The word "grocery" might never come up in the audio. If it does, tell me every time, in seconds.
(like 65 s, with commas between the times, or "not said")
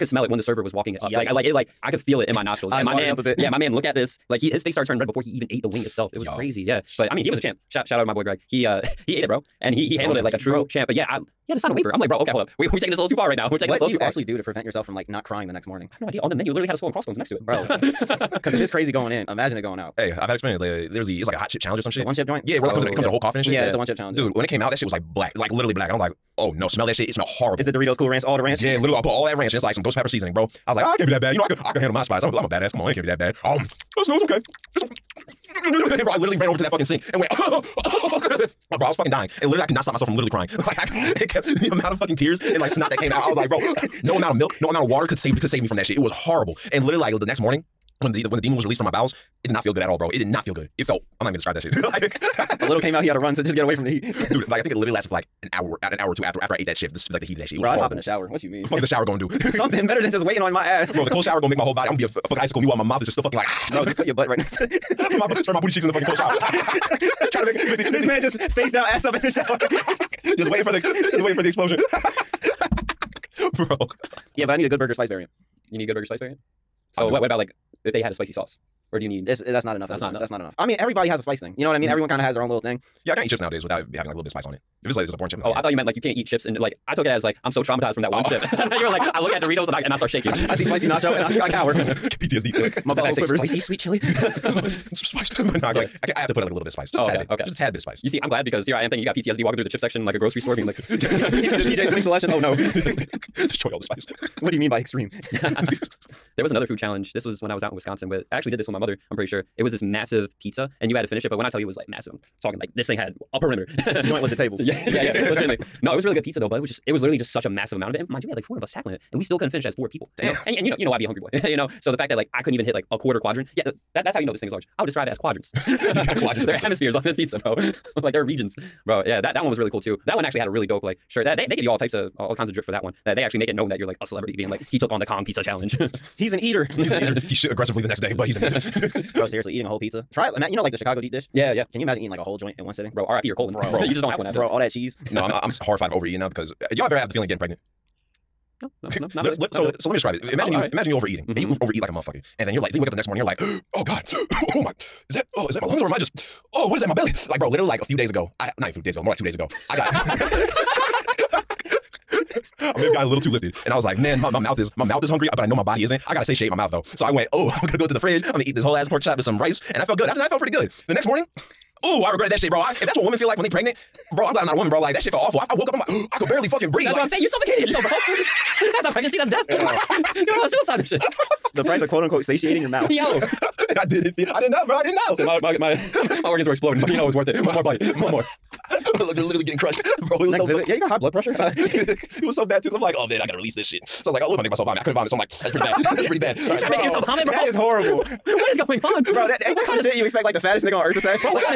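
100 s.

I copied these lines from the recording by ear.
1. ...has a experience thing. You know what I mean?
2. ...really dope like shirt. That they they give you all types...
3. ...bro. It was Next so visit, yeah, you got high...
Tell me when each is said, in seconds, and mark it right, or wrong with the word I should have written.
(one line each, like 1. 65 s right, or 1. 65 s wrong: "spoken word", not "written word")
1. 81 s wrong: "spice", not "experience"
2. 130 s right
3. 190 s right.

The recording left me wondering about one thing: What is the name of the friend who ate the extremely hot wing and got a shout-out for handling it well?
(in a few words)
Greg.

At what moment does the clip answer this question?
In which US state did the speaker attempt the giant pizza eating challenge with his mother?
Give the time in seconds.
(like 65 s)
107 s.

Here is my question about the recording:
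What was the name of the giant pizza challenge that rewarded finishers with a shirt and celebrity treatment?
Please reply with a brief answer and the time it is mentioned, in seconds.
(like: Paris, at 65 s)
Kong Pizza Challenge, at 135 s.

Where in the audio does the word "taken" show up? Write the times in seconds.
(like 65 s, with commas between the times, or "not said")
not said.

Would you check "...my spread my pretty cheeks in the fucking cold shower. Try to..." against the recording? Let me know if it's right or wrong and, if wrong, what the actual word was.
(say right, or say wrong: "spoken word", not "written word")
wrong: "booty", not "pretty".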